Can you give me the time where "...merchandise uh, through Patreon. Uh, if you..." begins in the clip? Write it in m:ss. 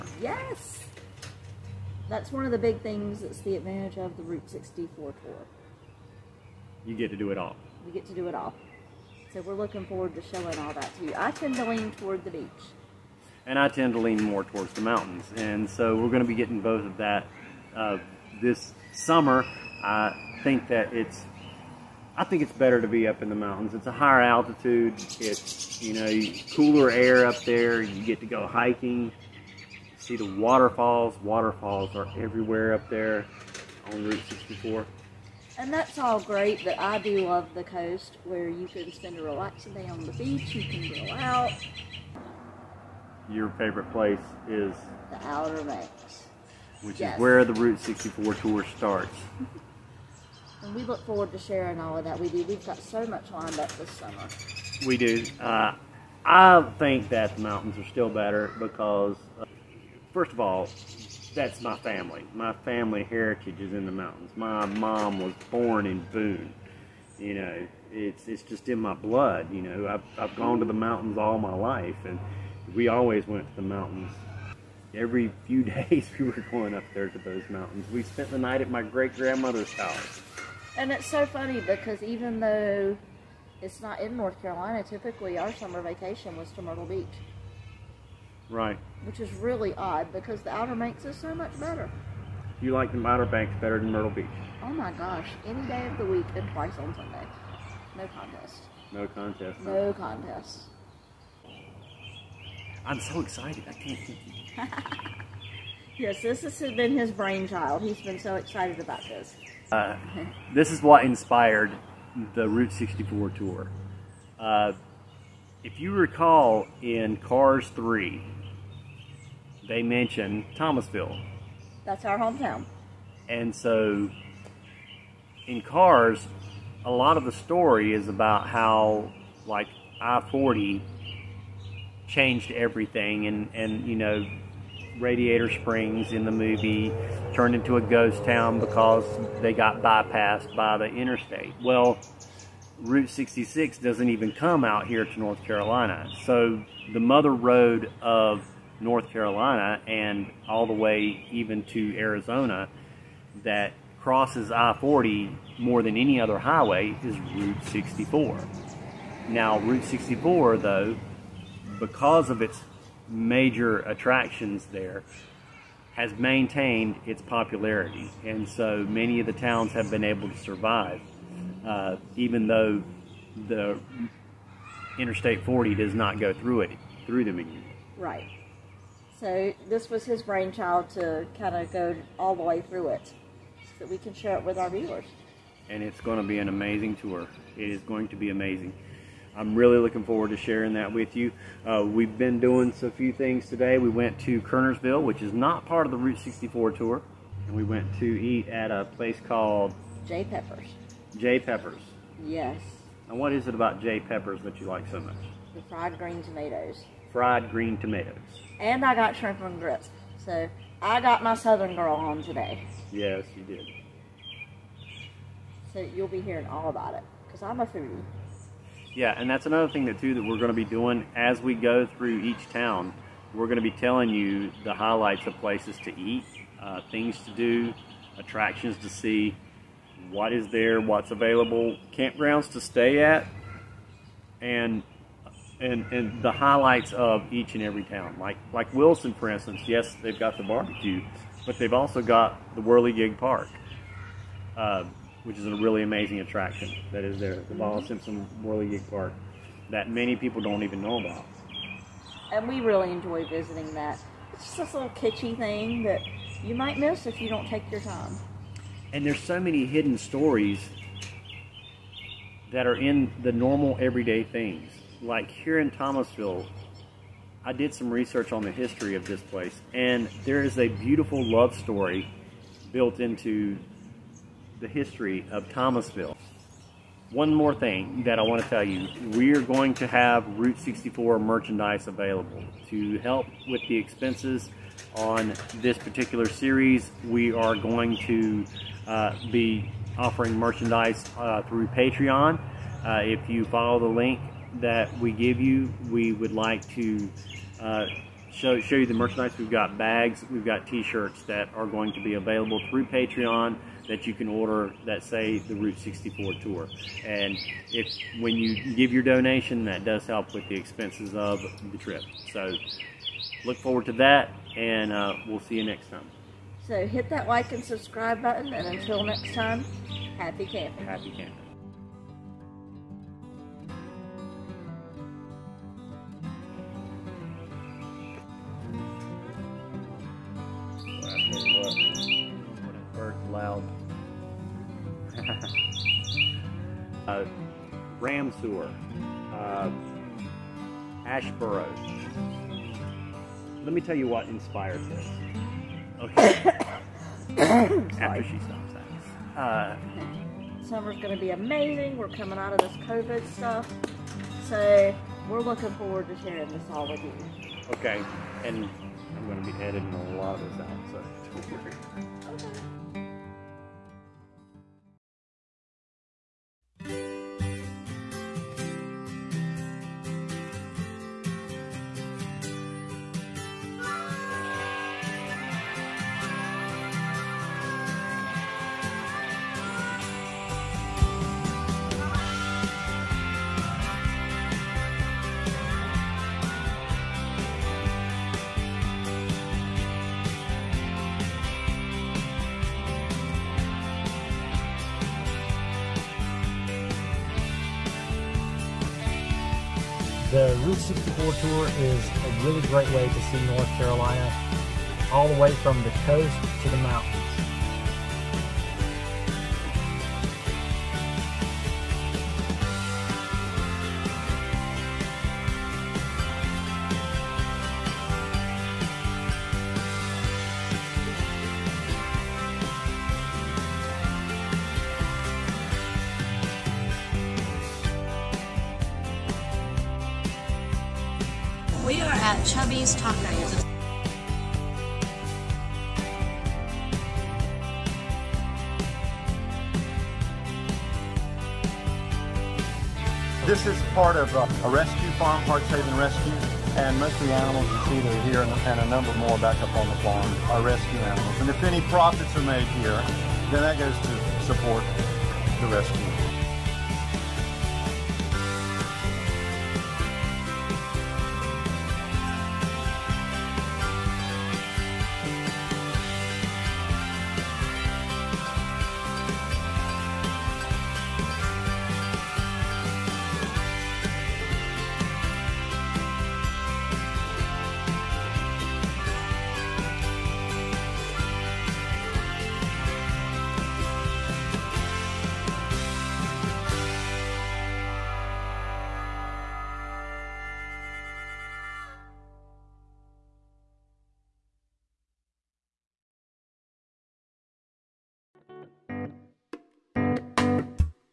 4:50.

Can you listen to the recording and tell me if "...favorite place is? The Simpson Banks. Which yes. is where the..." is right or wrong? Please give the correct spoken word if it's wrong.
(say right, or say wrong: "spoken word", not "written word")
wrong: "Outer", not "Simpson".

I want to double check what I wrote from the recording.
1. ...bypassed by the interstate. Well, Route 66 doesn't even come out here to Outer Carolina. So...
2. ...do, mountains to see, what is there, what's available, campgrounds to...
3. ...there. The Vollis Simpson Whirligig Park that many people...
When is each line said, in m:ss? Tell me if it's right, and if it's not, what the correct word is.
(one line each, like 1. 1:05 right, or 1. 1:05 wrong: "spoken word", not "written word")
1. 2:19 wrong: "North", not "Outer"
2. 3:47 wrong: "attractions", not "mountains"
3. 4:07 right.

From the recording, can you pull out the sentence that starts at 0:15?
And so we're going to be getting both of that uh, this summer.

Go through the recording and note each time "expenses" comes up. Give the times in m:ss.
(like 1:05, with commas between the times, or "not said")
4:43, 5:10.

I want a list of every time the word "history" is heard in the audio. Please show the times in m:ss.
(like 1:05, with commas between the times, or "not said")
4:28, 4:34.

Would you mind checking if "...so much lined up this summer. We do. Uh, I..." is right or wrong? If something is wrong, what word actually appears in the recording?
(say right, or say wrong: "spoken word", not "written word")
right.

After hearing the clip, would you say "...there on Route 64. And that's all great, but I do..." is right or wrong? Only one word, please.
right.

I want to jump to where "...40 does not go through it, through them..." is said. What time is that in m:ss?
2:55.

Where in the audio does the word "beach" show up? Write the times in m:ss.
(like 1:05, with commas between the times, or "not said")
0:12, 0:40, 1:26, 1:34.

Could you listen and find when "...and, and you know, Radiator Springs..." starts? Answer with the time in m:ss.
2:13.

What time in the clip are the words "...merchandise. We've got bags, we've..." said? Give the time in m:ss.
4:58.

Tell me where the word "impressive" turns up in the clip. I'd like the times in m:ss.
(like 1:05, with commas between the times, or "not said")
not said.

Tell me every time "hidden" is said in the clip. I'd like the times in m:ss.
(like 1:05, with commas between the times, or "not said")
4:19.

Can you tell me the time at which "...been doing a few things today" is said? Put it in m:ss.
3:12.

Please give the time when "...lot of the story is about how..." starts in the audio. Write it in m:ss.
2:06.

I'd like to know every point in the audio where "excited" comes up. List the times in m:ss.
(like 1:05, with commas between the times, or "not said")
1:43, 1:48.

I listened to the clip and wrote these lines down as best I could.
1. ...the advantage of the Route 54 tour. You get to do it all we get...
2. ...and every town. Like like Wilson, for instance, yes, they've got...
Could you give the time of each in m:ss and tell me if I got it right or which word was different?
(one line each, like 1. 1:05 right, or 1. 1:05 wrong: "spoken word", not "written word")
1. 0:03 wrong: "64", not "54"
2. 3:57 right.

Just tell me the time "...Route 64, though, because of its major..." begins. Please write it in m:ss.
2:39.